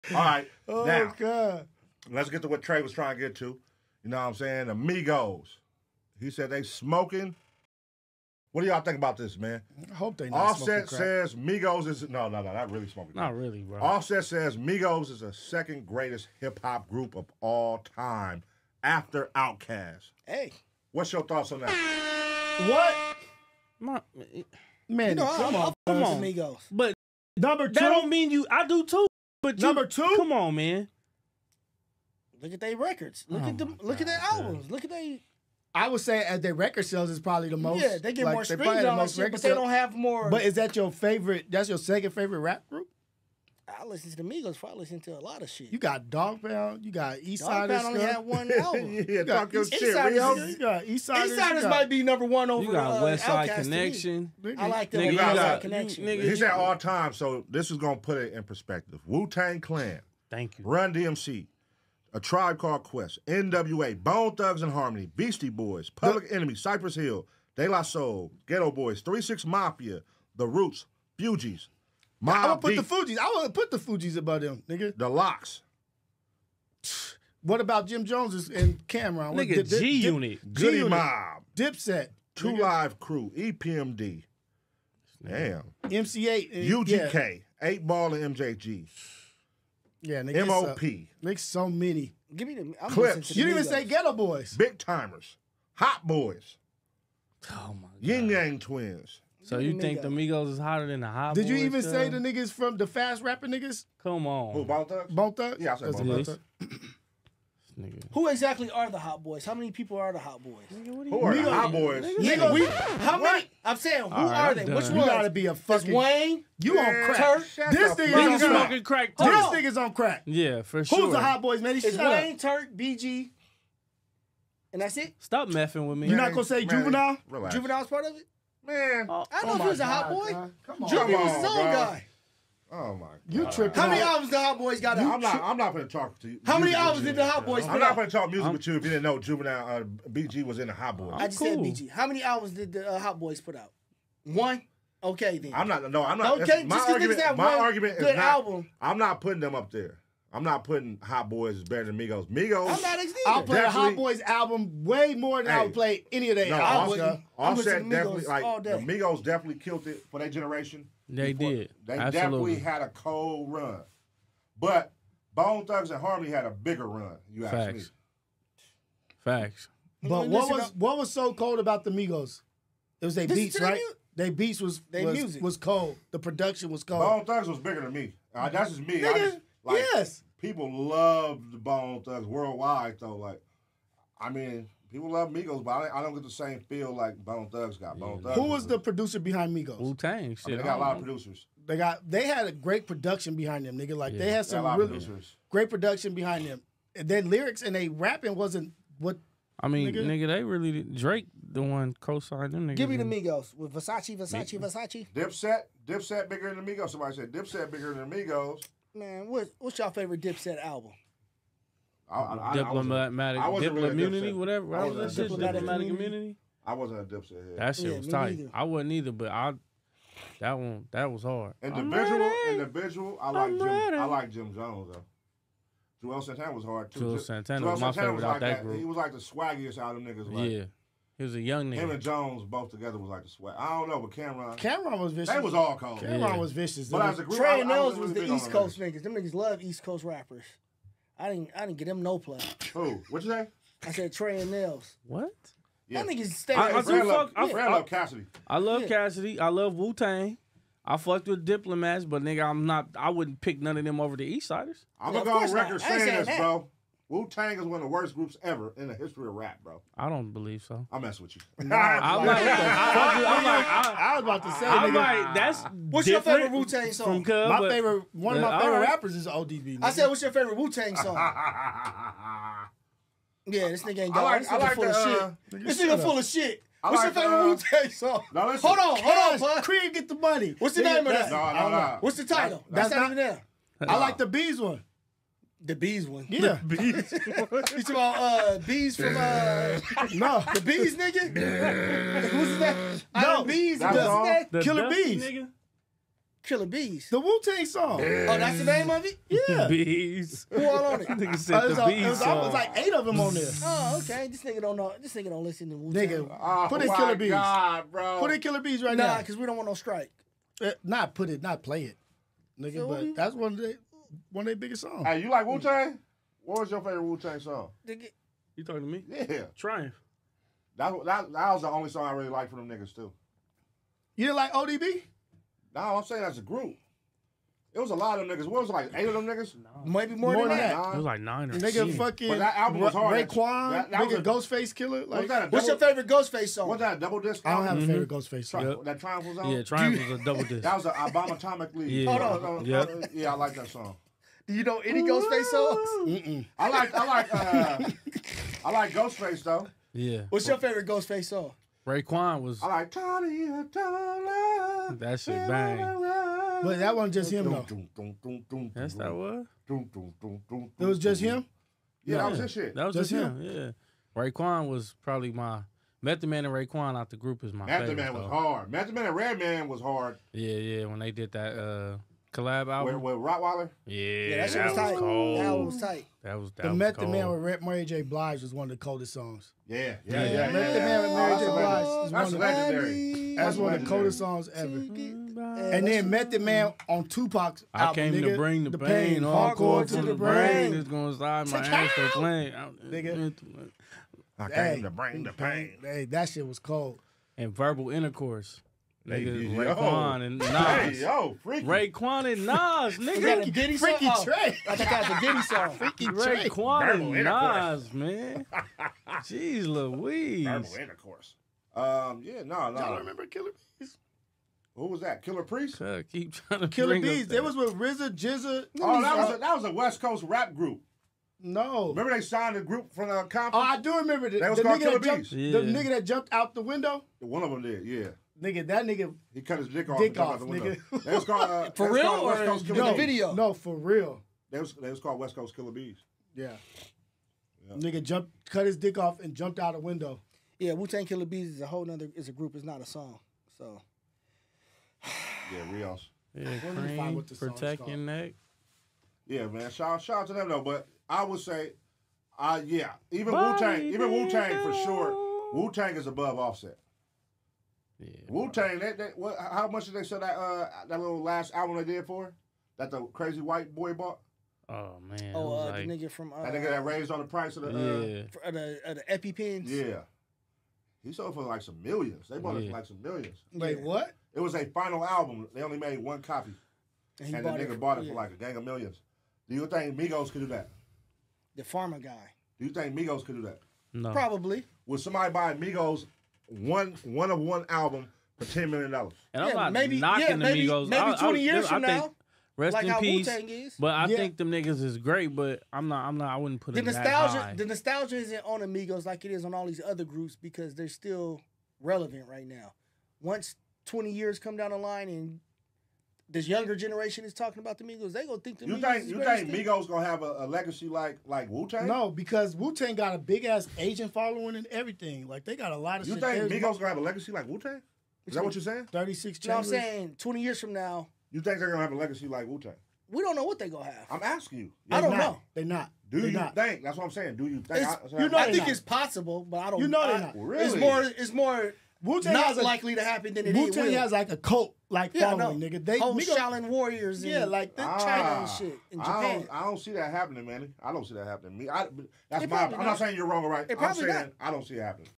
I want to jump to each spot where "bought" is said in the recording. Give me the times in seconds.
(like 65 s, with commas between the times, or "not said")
463 s, 472 s, 477 s.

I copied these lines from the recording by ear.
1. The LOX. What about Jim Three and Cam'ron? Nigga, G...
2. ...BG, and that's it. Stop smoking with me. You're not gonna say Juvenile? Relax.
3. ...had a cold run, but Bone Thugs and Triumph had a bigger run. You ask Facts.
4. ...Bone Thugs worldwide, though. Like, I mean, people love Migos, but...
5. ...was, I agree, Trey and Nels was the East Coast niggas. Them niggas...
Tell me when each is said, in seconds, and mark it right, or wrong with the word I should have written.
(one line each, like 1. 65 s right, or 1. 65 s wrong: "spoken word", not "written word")
1. 74 s wrong: "Jones", not "Three"
2. 122 s wrong: "messing", not "smoking"
3. 162 s wrong: "Harmony", not "Triumph"
4. 181 s right
5. 237 s right.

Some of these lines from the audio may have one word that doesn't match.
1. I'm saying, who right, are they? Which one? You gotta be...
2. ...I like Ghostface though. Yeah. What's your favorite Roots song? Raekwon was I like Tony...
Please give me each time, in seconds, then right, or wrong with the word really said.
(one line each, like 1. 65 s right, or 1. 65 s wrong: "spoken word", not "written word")
1. 113 s right
2. 348 s wrong: "Ghostface", not "Roots".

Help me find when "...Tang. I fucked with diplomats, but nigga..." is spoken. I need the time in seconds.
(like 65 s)
249 s.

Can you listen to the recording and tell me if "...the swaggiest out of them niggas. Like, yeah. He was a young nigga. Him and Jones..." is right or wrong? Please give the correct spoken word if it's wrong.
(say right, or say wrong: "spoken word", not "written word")
right.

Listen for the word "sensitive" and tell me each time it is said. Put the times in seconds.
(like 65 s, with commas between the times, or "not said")
not said.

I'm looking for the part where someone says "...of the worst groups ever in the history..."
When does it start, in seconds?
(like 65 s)
257 s.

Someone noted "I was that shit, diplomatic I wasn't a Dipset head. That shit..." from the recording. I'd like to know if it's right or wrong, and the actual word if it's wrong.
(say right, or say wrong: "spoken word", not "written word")
right.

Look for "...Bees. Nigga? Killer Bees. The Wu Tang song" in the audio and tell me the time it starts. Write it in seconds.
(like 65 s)
294 s.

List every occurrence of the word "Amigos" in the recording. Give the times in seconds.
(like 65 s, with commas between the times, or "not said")
4 s, 498 s.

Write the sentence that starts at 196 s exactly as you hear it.
And then lyrics and they rapping wasn't what.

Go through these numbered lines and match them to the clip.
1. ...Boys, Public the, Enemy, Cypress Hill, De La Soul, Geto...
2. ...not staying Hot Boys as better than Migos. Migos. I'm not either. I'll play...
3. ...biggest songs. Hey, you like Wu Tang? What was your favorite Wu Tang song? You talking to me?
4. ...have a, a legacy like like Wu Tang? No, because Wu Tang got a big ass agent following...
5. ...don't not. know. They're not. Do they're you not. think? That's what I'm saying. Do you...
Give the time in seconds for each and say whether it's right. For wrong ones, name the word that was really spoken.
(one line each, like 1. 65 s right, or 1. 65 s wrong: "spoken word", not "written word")
1. 65 s right
2. 150 s wrong: "putting", not "staying"
3. 314 s right
4. 510 s right
5. 525 s right.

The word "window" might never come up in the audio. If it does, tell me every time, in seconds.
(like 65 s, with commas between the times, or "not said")
426 s, 439 s.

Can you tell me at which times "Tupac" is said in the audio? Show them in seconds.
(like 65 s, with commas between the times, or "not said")
387 s.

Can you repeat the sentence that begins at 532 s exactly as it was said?
Wu-Tang not a, likely to happen than it Wu-Tang is.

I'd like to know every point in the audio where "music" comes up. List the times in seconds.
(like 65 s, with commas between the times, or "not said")
138 s, 175 s.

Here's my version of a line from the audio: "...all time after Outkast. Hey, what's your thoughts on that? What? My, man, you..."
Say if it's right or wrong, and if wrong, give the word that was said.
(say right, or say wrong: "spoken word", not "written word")
right.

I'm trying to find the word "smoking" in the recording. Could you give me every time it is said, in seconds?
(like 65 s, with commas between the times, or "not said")
6 s, 12 s, 118 s.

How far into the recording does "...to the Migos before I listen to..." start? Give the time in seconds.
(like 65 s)
44 s.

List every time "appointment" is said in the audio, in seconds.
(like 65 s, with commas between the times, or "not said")
not said.